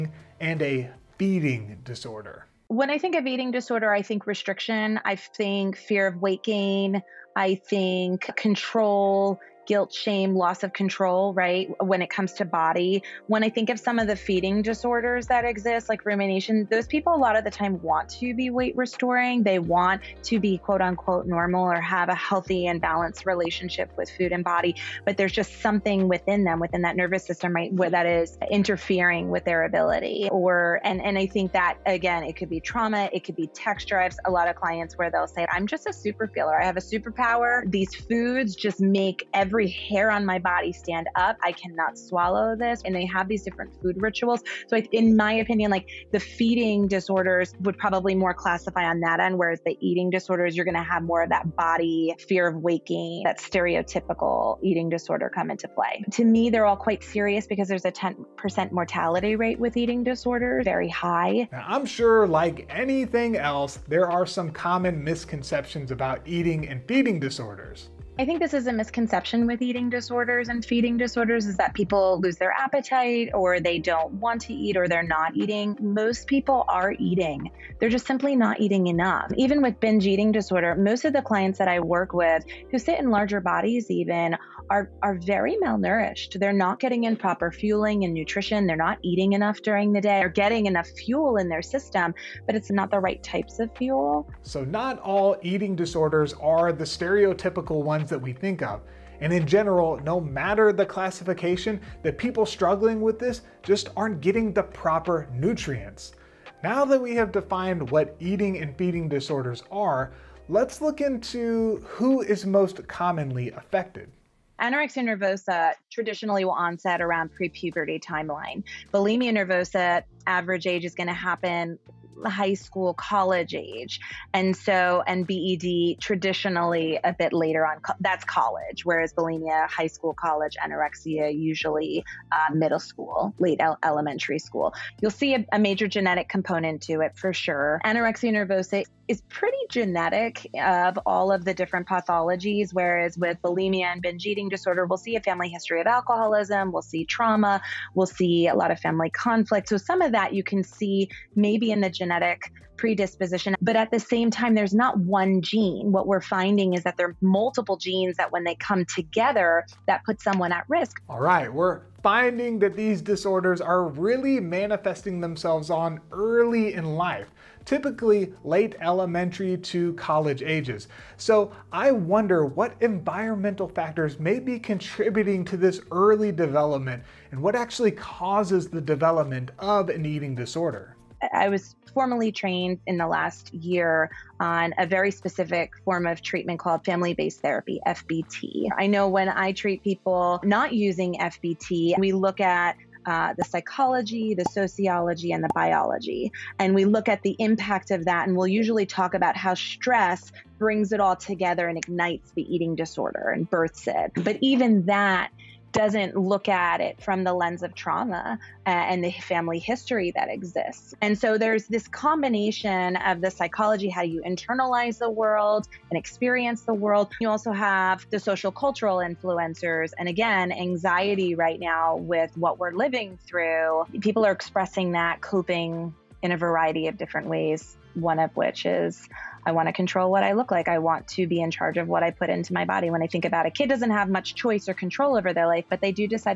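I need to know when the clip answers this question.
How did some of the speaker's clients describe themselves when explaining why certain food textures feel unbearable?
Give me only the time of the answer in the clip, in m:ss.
0:35.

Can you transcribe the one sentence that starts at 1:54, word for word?
Anorexia nervosa traditionally will onset around pre-puberty timeline.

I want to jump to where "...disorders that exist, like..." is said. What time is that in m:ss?
0:14.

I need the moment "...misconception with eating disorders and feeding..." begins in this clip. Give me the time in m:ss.
1:08.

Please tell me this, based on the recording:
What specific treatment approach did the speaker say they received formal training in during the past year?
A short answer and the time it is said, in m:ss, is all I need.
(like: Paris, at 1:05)
Family based therapy, at 3:06.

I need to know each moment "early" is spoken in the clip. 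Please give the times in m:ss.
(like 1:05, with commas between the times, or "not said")
2:46, 2:55.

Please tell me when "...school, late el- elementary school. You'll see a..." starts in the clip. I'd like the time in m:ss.
2:12.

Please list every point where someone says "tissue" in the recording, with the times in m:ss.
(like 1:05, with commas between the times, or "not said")
not said.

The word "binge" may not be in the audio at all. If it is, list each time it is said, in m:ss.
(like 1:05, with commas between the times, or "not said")
1:19, 2:24.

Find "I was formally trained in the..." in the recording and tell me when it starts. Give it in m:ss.
3:01.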